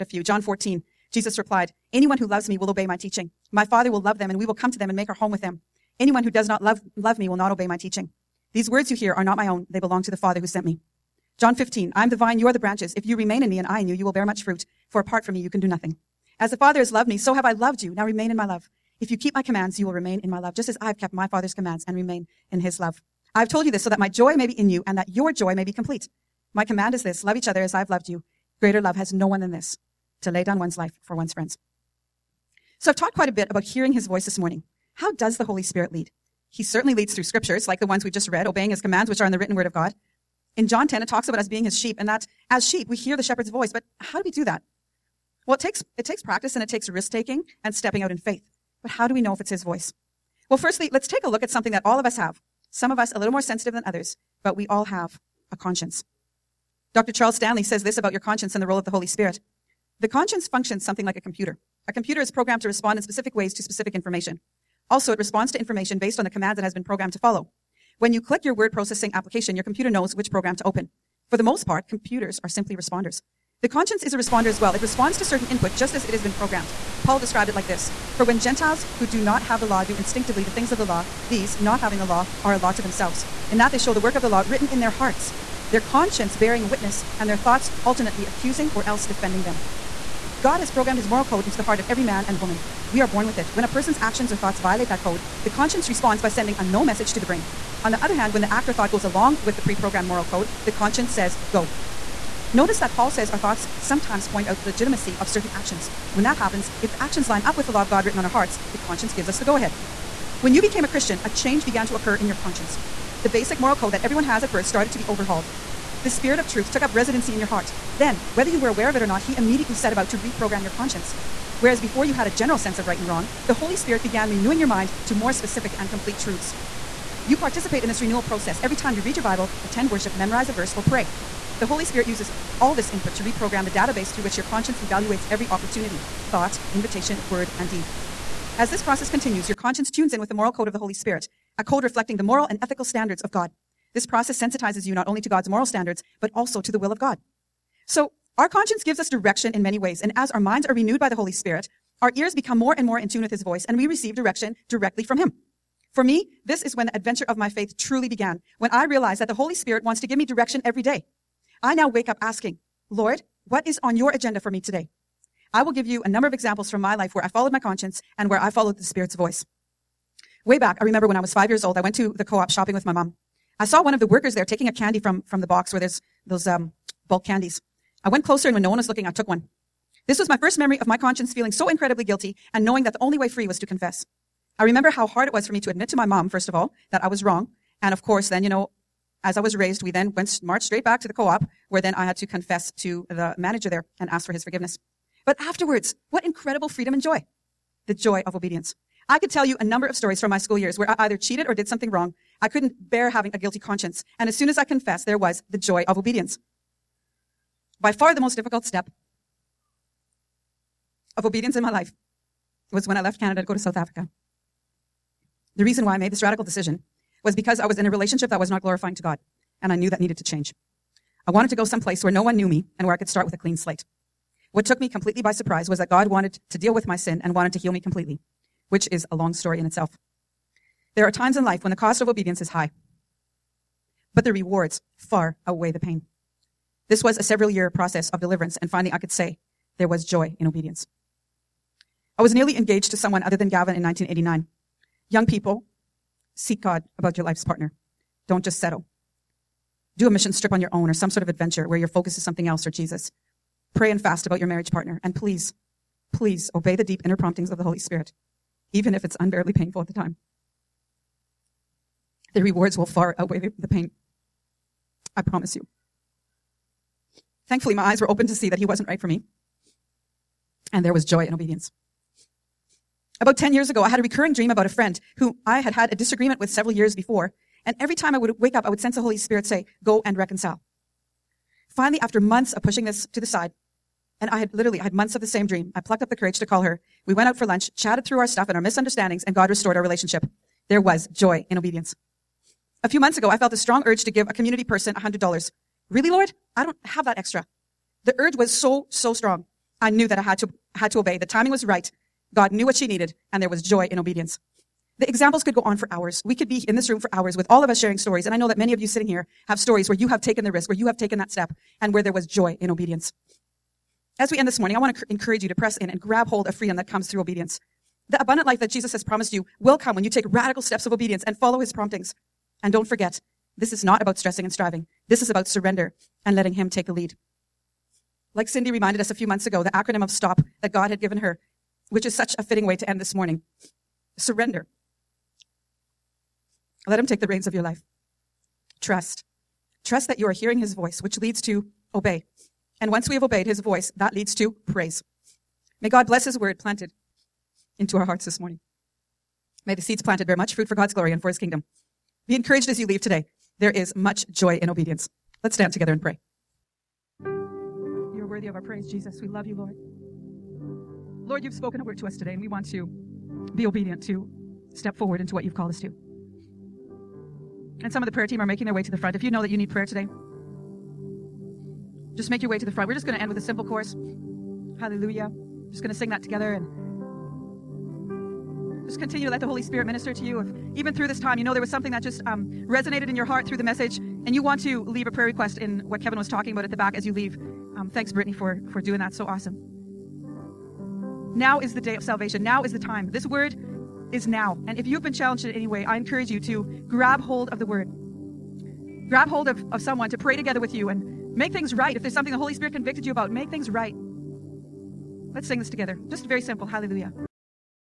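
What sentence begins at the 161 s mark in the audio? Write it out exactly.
I now wake up asking, Lord, what is on your agenda for me today?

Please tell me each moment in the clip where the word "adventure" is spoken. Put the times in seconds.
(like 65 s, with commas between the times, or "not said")
156 s, 251 s.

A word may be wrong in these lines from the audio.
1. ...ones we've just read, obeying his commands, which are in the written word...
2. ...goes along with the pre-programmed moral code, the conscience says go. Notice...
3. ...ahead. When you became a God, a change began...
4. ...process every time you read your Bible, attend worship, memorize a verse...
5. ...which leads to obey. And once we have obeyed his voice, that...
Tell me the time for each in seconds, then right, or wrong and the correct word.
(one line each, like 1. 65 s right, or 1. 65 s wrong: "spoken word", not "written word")
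1. 37 s right
2. 98 s right
3. 109 s wrong: "Christian", not "God"
4. 128 s right
5. 341 s right.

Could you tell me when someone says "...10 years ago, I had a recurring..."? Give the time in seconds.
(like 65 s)
273 s.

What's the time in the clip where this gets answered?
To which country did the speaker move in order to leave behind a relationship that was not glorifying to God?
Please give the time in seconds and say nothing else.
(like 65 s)
213 s.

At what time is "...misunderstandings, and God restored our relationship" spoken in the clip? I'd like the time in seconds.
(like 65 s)
288 s.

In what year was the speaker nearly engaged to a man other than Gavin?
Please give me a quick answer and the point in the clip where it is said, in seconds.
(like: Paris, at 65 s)
1989, at 243 s.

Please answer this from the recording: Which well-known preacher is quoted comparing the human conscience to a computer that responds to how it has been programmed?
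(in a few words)
Charles Stanley.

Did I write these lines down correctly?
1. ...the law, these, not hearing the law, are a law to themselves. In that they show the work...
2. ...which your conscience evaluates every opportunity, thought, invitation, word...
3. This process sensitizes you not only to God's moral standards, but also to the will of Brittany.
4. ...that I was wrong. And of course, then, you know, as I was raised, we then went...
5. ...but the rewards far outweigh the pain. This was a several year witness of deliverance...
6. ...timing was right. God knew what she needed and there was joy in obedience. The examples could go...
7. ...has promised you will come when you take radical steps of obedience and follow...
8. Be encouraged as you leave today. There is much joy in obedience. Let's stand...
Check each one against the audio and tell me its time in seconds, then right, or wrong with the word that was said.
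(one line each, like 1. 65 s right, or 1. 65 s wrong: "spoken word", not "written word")
1. 80 s wrong: "having", not "hearing"
2. 134 s right
3. 143 s wrong: "God", not "Brittany"
4. 186 s right
5. 234 s wrong: "process", not "witness"
6. 301 s right
7. 318 s right
8. 352 s right.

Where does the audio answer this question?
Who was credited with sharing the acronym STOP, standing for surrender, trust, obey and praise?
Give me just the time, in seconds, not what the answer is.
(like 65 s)
328 s.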